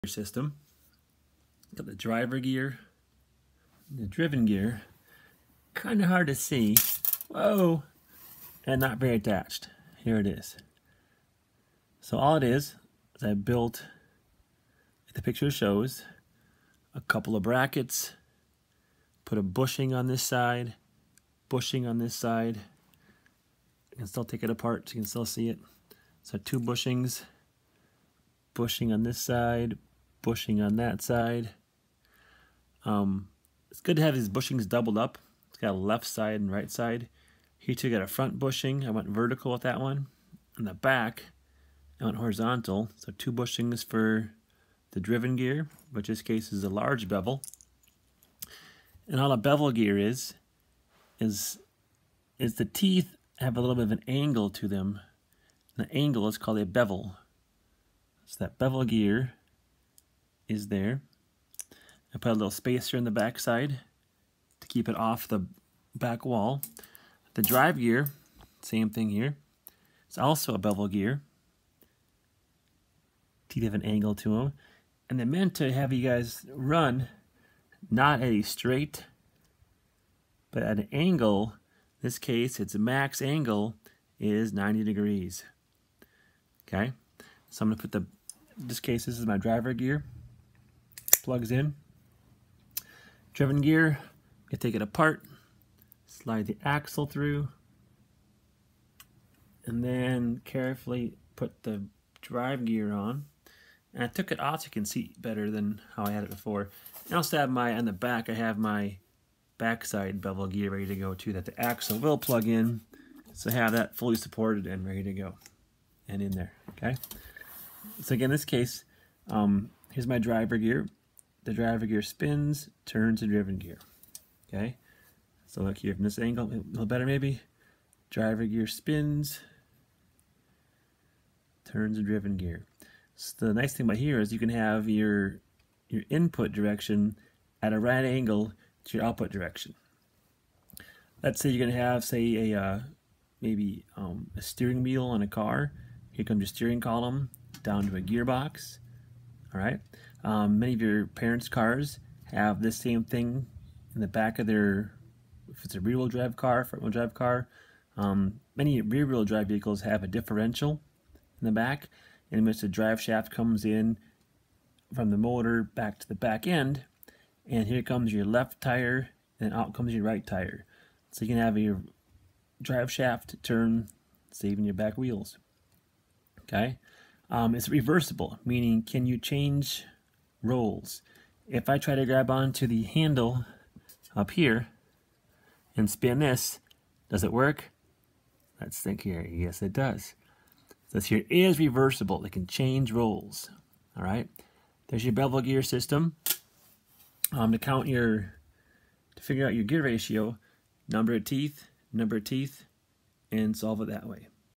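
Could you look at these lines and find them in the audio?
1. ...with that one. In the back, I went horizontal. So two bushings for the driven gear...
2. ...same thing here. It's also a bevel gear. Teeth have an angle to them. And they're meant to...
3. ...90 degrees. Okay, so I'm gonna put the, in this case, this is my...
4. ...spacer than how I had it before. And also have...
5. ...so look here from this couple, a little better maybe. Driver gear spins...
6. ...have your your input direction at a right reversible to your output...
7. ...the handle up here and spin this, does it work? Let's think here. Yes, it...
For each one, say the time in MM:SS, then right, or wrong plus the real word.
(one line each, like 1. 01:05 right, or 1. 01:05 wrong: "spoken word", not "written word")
1. 00:39 right
2. 01:08 right
3. 01:24 right
4. 01:45 wrong: "better", not "spacer"
5. 02:05 wrong: "angle", not "couple"
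6. 02:14 wrong: "angle", not "reversible"
7. 03:02 right.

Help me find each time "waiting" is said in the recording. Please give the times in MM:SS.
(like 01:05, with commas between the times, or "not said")
not said.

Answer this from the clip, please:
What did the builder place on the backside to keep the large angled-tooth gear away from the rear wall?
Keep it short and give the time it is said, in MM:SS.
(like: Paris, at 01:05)
a little spacer, at 01:02.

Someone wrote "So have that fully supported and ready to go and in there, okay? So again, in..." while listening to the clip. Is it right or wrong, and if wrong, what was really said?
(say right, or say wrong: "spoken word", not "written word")
right.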